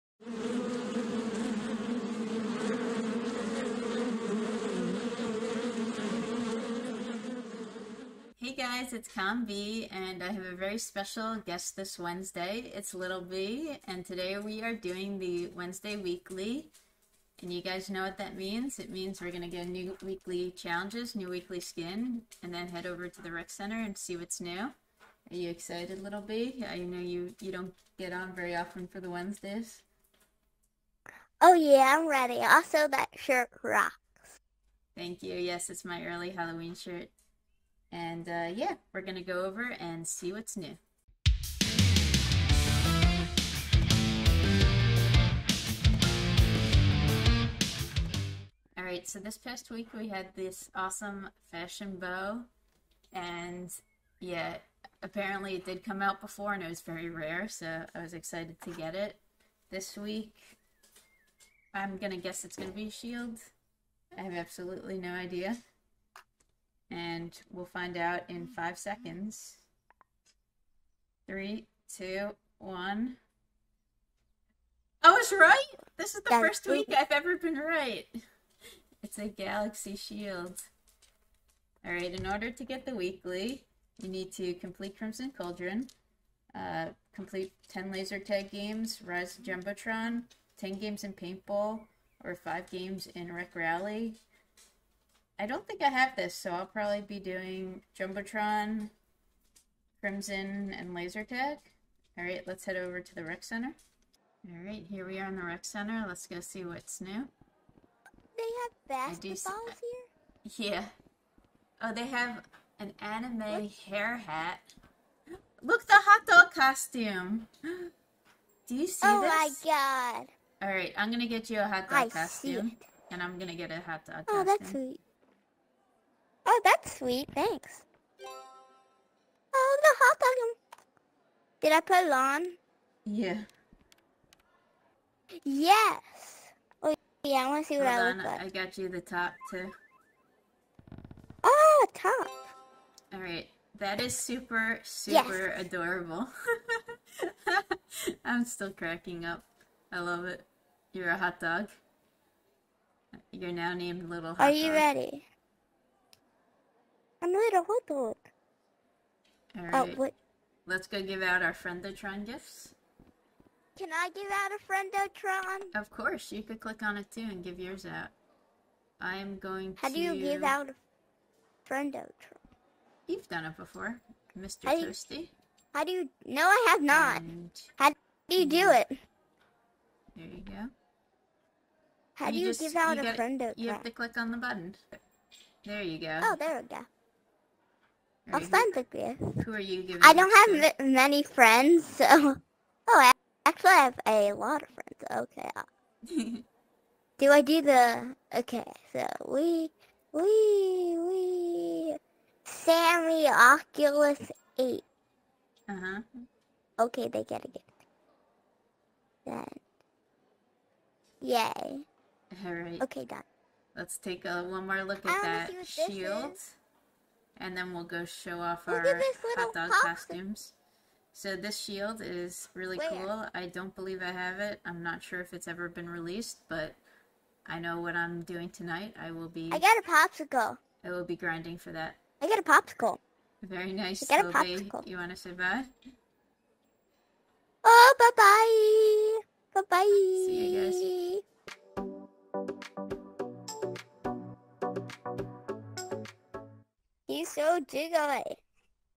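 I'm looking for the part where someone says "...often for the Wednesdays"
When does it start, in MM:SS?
00:28.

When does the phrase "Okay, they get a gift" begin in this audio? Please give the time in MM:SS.
03:26.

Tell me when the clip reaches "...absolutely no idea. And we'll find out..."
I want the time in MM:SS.
01:04.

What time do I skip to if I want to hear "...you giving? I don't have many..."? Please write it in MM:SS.
03:09.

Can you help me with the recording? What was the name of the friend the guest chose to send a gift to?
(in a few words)
Sammy Oculus Eight.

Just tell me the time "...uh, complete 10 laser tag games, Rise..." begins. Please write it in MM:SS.
01:26.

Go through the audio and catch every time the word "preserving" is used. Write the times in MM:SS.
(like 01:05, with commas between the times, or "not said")
not said.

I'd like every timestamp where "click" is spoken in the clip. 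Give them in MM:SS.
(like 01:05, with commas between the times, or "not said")
02:46, 03:03.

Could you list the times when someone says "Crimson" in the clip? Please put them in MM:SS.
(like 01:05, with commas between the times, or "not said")
01:24, 01:39.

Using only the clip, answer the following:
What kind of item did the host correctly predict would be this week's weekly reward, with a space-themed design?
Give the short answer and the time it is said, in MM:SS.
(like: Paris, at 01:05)
Galaxy shield, at 01:19.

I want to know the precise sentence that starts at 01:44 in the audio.
All right, here we are in the Rec Center.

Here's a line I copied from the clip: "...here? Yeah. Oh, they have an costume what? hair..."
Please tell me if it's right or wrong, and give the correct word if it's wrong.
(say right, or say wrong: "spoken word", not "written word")
wrong: "anime", not "costume".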